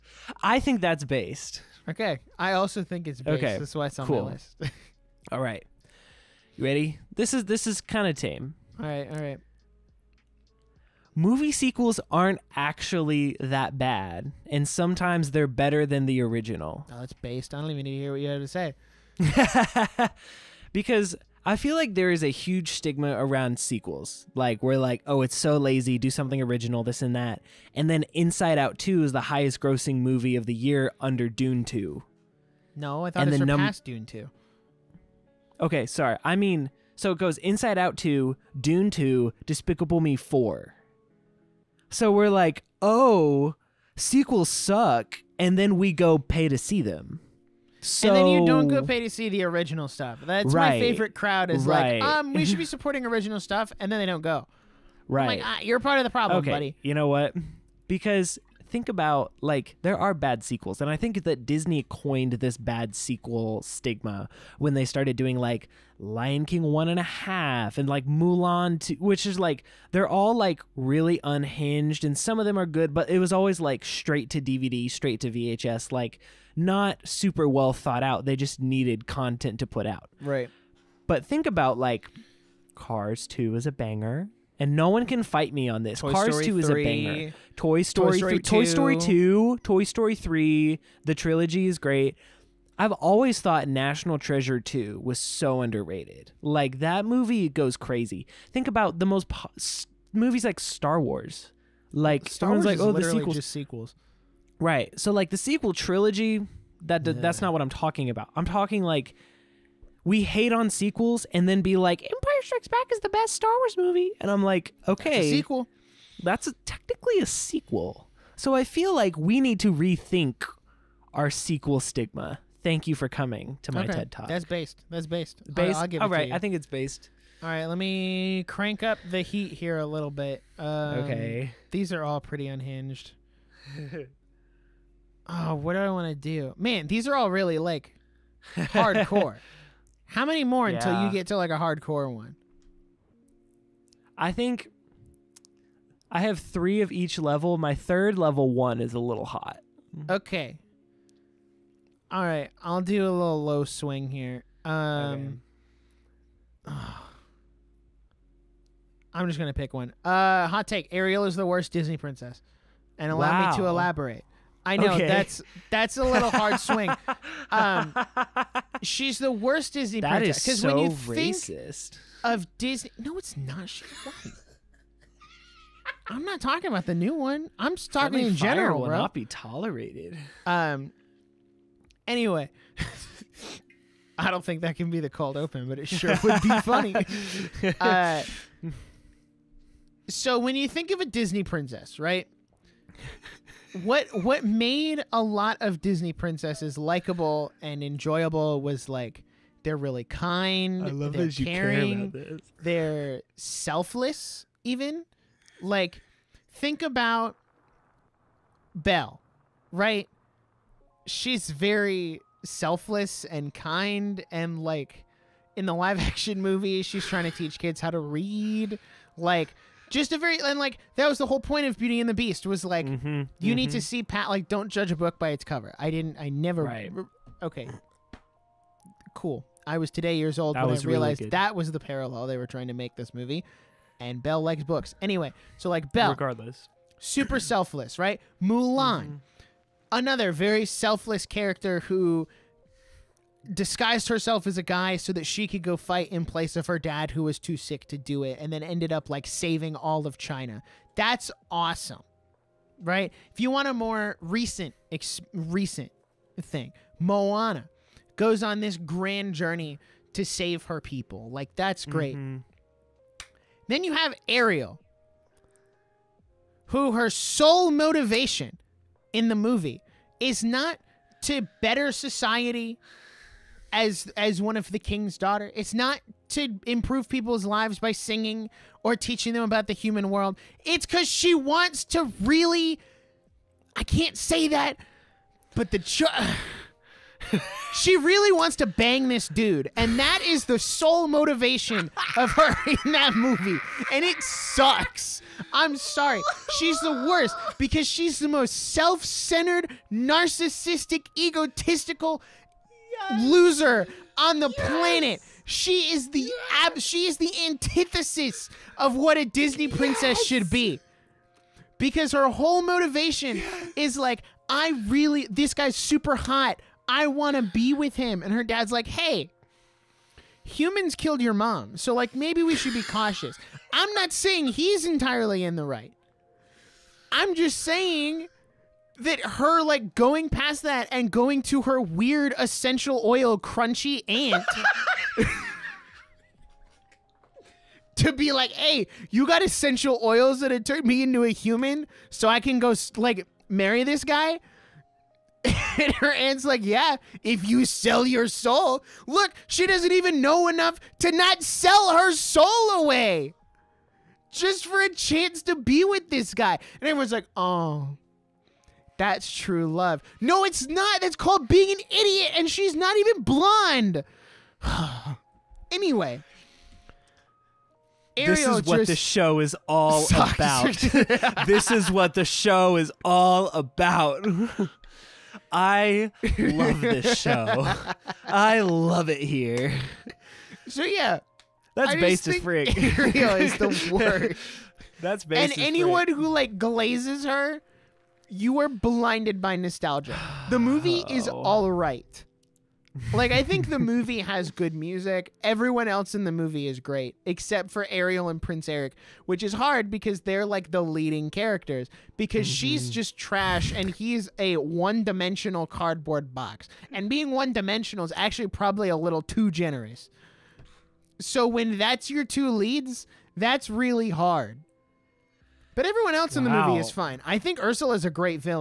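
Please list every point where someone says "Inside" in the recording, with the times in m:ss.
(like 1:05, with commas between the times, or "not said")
0:28, 0:37.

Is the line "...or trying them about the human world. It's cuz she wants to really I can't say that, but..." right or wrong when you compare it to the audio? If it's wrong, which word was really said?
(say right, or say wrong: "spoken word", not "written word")
wrong: "teaching", not "trying".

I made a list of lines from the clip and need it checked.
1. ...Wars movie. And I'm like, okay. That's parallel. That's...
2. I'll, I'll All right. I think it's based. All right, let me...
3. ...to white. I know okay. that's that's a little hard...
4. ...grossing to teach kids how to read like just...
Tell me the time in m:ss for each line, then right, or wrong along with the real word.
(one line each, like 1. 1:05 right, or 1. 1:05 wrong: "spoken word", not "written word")
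1. 1:53 wrong: "sequel", not "parallel"
2. 2:05 right
3. 2:43 wrong: "elaborate", not "white"
4. 3:37 wrong: "trying", not "grossing".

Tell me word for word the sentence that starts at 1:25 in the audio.
Toy Cars Story 2 is 3, a banger.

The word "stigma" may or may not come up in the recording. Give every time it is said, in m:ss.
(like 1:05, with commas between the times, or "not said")
0:22, 1:03, 2:01.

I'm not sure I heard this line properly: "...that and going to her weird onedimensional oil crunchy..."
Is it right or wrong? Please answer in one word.
wrong.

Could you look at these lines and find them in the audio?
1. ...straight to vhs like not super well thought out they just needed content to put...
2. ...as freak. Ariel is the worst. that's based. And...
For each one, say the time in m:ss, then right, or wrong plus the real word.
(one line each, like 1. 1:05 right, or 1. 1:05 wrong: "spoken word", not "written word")
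1. 1:14 right
2. 6:22 right.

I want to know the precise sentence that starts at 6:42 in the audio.
she's just trash and he's a one-dimensional cardboard box.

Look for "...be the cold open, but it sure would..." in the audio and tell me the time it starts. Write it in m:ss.
3:04.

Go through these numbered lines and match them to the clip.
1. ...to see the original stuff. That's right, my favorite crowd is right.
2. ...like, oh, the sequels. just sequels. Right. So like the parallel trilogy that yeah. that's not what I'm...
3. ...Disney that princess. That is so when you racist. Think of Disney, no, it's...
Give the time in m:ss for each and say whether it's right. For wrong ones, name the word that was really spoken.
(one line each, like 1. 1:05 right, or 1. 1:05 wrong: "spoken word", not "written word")
1. 0:48 right
2. 1:42 wrong: "sequel", not "parallel"
3. 2:49 right.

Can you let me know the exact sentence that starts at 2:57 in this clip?
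I'm just talking Friendly in general.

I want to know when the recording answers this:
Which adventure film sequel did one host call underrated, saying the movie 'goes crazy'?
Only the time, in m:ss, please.
1:33.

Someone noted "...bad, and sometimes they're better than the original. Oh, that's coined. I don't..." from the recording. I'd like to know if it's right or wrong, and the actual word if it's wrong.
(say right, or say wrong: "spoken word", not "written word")
wrong: "based", not "coined".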